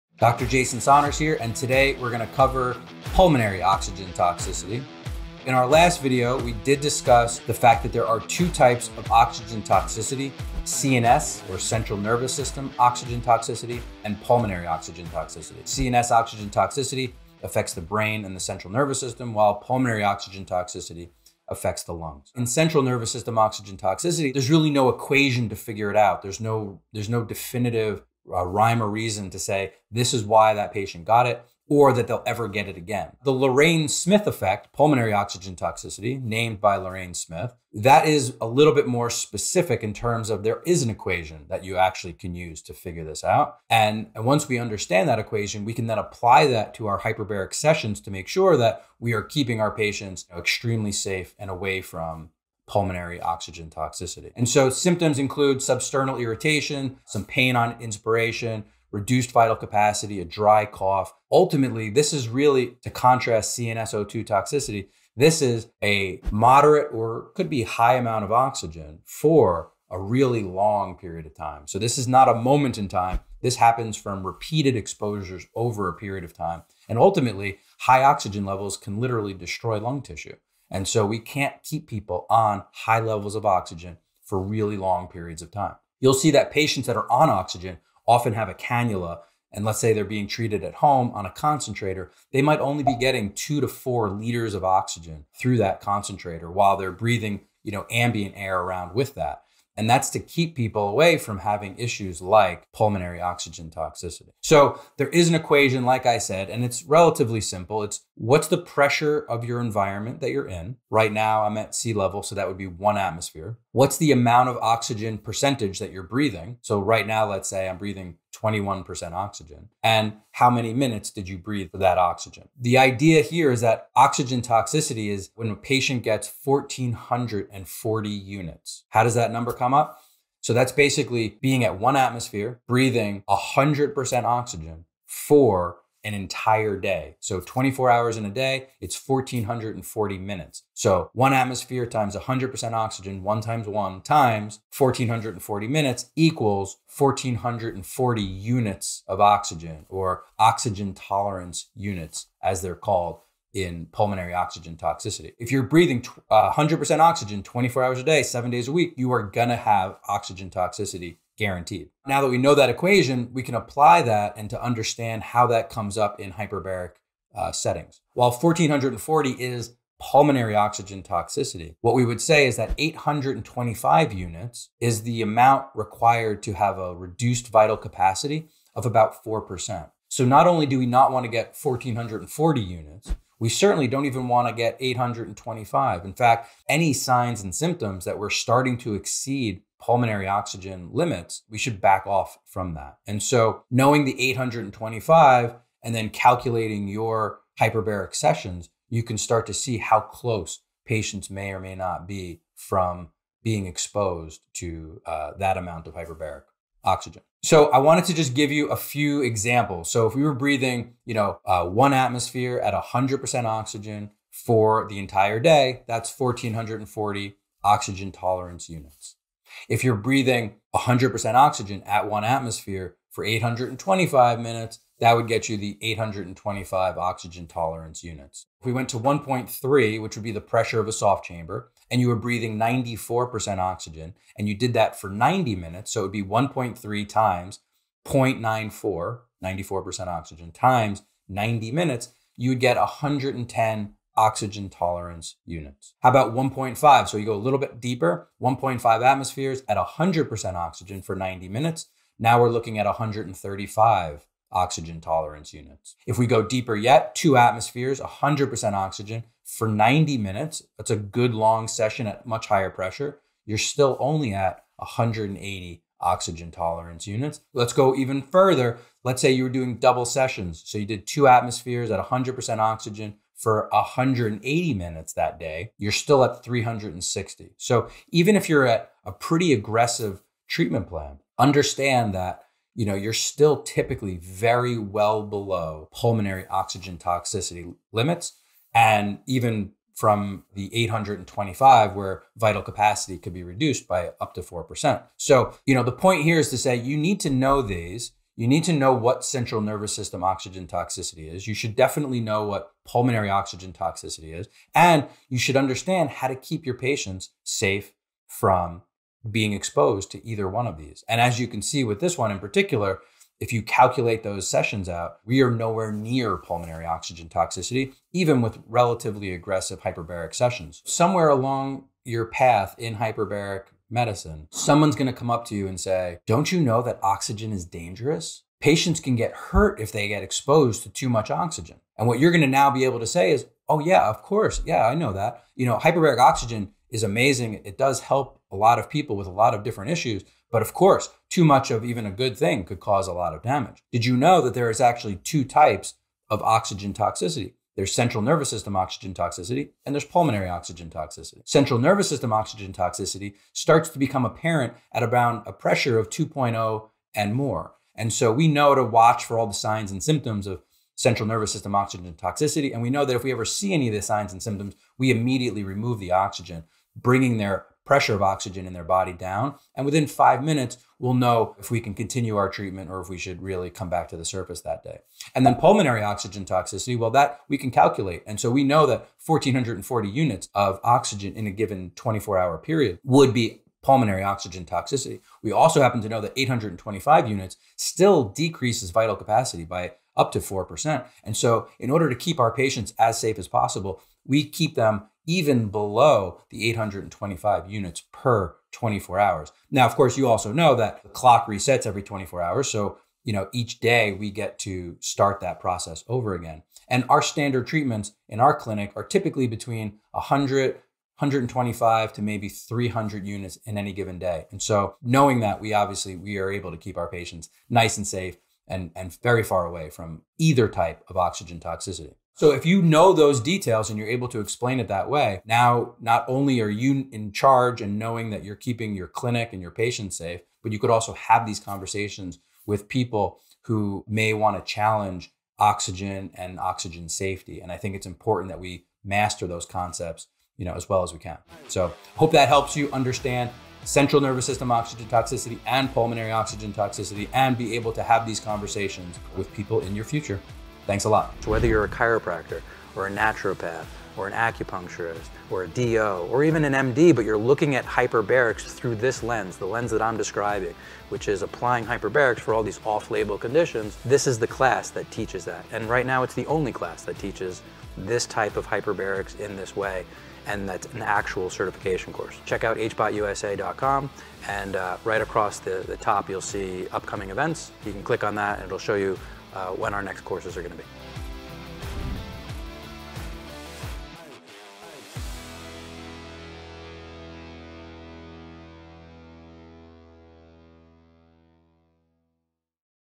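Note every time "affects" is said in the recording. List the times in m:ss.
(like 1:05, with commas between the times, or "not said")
0:17, 0:21.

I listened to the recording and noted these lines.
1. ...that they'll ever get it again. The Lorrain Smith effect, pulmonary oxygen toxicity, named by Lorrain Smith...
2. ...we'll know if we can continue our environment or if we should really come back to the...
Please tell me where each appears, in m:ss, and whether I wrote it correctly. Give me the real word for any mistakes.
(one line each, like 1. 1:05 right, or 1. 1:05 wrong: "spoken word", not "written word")
1. 0:31 right
2. 6:10 wrong: "treatment", not "environment".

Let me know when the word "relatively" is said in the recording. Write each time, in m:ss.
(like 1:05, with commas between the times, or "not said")
1:46, 5:18.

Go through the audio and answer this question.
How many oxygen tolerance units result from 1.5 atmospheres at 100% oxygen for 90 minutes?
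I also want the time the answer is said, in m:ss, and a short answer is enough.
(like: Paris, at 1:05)
135, at 4:12.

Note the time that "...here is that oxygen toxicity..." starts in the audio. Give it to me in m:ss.
2:03.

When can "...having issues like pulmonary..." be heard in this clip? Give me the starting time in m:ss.
1:41.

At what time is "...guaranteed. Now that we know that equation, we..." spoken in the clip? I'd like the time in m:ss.
2:41.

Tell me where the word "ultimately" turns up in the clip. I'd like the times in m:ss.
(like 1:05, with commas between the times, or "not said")
1:01, 1:16.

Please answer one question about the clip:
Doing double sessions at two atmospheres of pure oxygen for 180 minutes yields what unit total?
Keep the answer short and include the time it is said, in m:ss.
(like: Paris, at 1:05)
360, at 4:36.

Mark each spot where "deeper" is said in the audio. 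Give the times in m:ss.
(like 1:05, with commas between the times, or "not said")
4:07, 4:16.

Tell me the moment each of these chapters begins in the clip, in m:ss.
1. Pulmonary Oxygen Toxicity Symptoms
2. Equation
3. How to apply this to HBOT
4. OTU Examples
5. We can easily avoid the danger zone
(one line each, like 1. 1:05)
1. 0:54
2. 1:44
3. 2:41
4. 3:27
5. 5:10.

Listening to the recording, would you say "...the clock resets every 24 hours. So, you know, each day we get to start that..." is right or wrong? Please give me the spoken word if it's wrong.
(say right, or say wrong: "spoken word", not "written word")
right.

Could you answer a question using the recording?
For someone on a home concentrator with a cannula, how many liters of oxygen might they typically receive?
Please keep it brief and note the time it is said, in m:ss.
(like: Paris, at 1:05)
2 to 4 liters, at 1:33.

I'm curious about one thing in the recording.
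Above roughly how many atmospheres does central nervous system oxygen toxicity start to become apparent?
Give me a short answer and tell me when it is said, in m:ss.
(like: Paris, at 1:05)
2.0, at 5:56.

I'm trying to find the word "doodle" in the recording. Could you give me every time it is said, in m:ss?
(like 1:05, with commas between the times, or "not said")
not said.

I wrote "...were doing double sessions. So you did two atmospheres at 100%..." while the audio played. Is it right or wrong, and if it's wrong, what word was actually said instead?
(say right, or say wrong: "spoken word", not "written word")
right.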